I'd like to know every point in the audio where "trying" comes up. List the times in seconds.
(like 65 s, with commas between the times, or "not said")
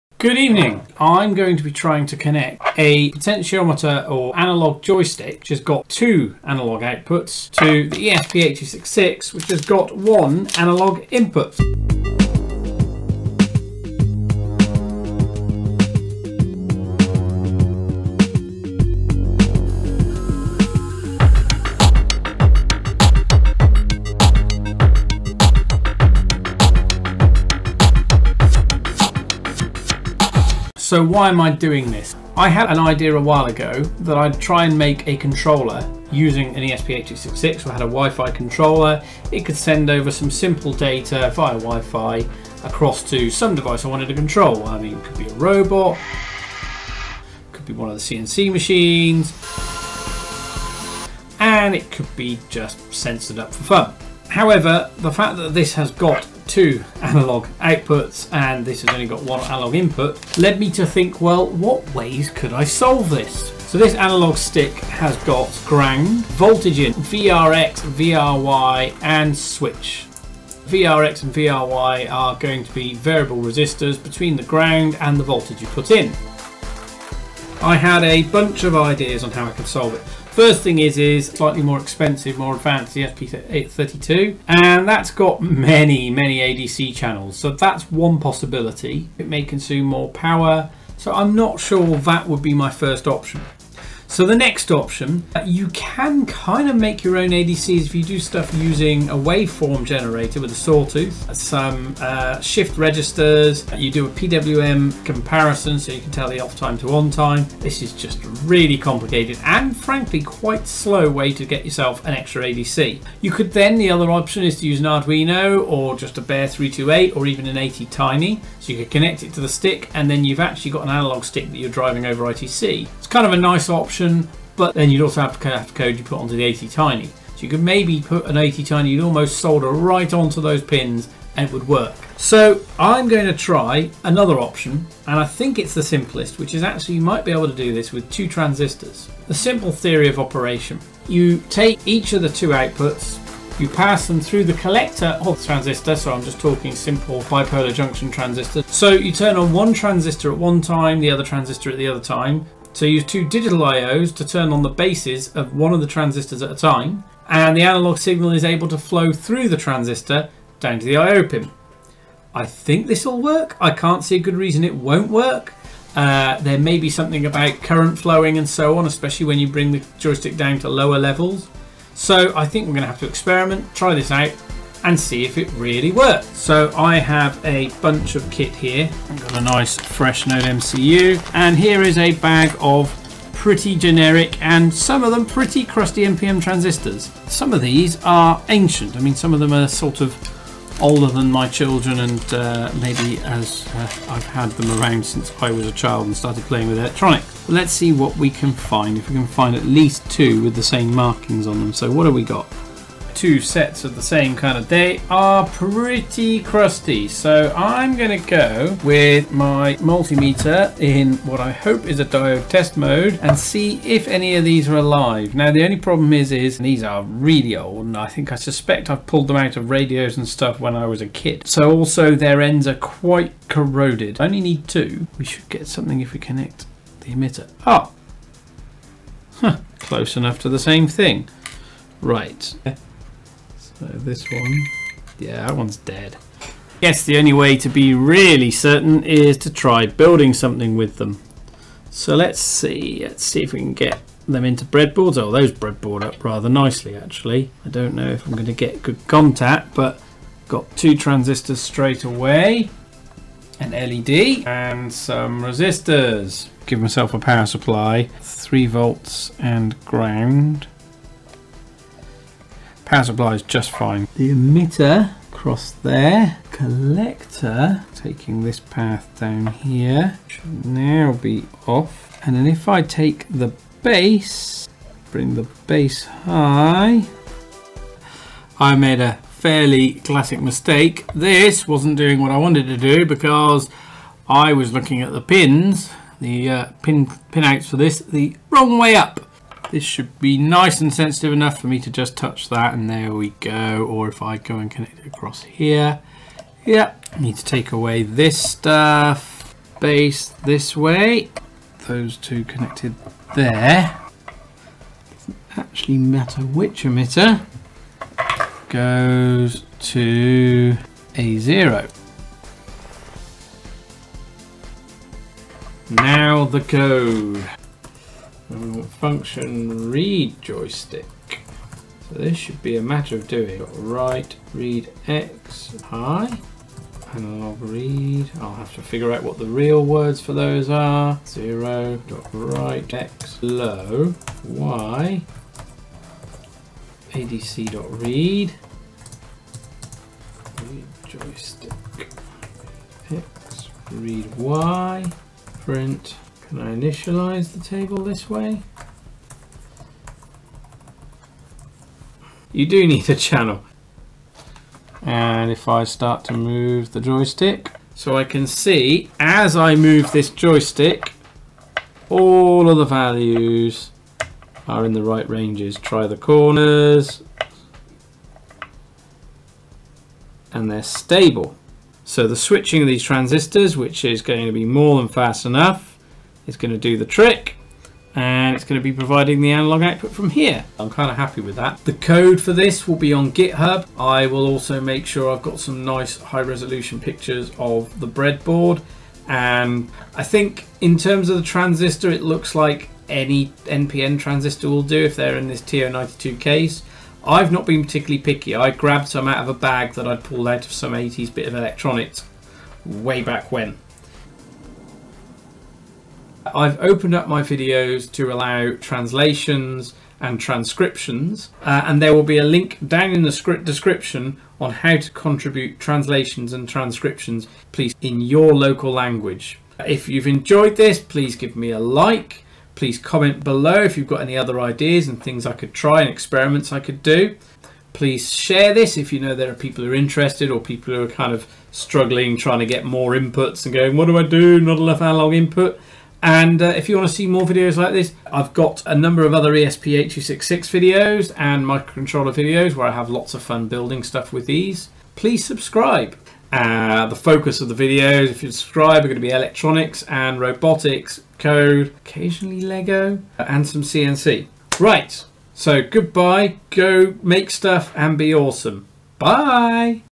1 s, 432 s.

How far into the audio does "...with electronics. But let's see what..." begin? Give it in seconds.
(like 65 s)
196 s.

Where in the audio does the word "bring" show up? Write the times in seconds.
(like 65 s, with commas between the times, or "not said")
169 s, 275 s.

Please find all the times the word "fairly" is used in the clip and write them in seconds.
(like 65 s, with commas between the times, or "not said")
279 s.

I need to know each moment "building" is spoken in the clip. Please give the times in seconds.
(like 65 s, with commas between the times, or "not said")
239 s, 443 s.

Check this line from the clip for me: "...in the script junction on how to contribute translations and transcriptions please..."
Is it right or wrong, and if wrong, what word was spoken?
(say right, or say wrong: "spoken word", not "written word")
wrong: "description", not "junction".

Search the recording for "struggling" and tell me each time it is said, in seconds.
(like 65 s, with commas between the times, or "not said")
431 s.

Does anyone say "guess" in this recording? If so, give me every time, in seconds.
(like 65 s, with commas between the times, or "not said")
236 s.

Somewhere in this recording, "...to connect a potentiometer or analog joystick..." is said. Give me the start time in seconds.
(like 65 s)
2 s.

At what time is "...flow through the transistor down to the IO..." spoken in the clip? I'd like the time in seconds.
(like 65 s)
158 s.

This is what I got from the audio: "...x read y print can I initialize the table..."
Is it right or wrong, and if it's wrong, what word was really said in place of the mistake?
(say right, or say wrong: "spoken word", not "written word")
right.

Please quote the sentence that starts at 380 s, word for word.
I'm kind of happy with that.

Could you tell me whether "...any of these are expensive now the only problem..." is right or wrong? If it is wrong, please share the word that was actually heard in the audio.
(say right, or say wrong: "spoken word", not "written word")
wrong: "alive", not "expensive".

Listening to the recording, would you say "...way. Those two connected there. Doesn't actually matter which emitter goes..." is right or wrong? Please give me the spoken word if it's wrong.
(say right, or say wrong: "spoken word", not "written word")
right.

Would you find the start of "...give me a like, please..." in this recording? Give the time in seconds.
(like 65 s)
421 s.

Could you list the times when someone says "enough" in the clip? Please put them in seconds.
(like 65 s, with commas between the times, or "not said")
230 s, 291 s, 375 s, 434 s.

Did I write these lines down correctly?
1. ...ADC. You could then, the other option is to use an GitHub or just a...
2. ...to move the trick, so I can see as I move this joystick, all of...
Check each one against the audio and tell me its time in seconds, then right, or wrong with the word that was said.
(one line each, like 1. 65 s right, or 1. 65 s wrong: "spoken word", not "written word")
1. 112 s wrong: "Arduino", not "GitHub"
2. 356 s wrong: "joystick", not "trick".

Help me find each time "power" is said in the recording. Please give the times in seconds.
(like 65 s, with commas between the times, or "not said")
90 s, 257 s, 262 s.